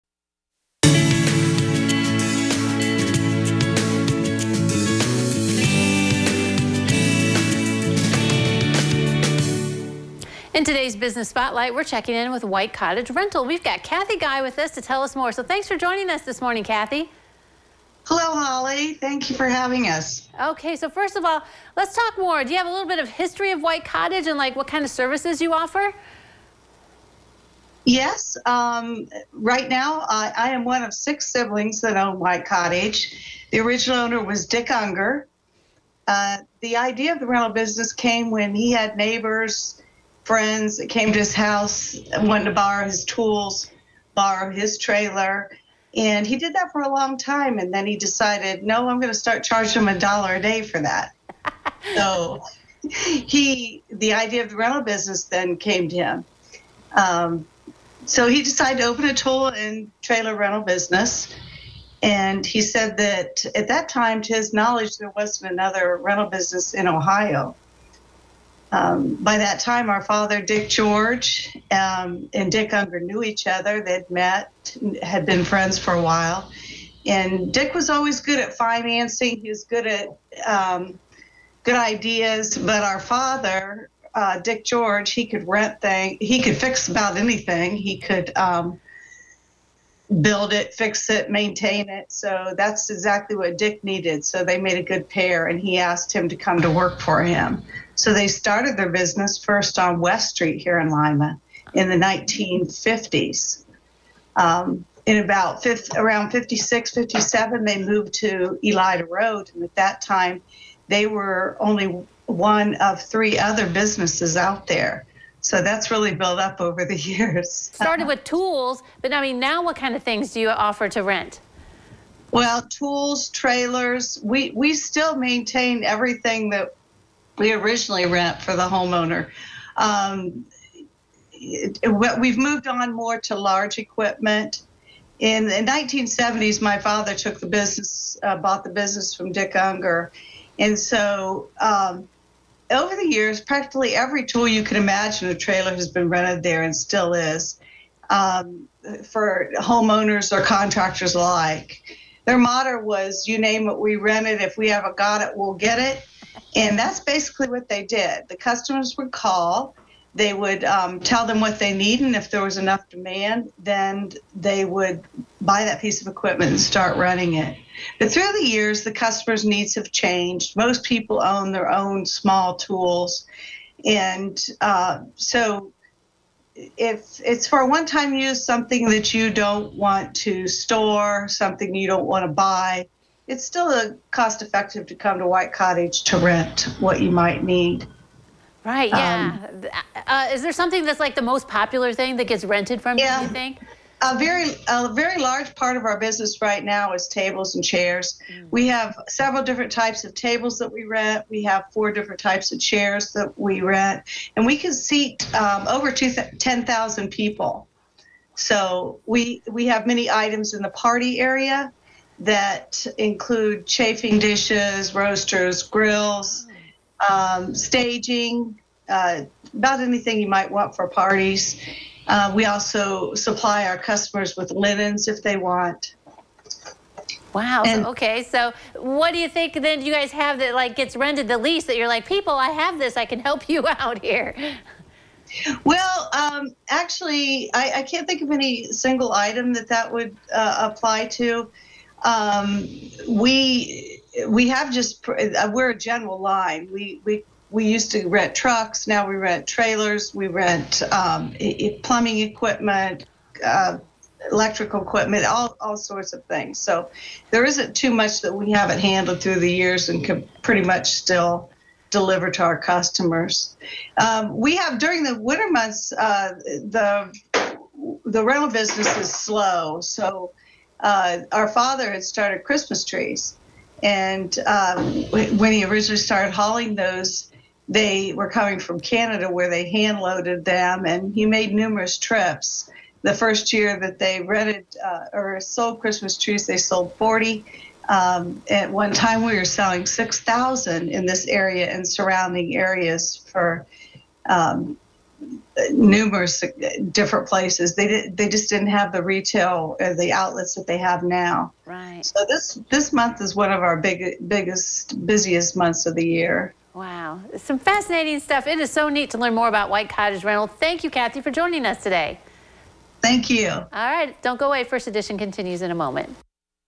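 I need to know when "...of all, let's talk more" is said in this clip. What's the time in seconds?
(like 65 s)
21 s.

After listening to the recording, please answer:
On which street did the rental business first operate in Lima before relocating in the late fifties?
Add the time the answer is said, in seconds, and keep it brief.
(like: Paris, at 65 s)
West Street, at 99 s.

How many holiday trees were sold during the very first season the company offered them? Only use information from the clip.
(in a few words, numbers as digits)
40.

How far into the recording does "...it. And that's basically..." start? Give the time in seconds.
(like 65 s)
155 s.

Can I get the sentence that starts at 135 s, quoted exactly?
In the 1970s, my father took the business, uh, bought the business from Dick Unger.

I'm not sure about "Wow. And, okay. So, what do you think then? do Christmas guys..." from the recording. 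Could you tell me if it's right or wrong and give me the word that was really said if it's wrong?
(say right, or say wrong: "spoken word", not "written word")
wrong: "You", not "Christmas".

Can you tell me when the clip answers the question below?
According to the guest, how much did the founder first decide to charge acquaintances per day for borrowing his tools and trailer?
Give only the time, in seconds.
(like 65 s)
49 s.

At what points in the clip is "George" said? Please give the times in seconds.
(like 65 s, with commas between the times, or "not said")
70 s, 84 s.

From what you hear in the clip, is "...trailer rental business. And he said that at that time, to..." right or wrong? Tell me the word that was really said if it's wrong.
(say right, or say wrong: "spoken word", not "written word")
right.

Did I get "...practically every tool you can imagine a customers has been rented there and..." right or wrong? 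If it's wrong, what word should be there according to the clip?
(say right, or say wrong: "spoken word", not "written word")
wrong: "trailer", not "customers".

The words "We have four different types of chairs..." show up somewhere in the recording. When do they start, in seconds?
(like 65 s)
201 s.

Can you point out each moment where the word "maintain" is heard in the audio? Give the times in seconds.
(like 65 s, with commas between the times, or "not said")
91 s, 125 s.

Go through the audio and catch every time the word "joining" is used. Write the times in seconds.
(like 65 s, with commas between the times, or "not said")
15 s, 311 s.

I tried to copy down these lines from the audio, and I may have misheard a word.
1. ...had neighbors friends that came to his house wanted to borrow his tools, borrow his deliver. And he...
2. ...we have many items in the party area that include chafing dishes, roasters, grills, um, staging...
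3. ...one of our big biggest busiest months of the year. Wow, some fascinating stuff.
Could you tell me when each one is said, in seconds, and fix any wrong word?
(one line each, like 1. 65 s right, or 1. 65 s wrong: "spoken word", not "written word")
1. 38 s wrong: "trailer", not "deliver"
2. 209 s right
3. 303 s right.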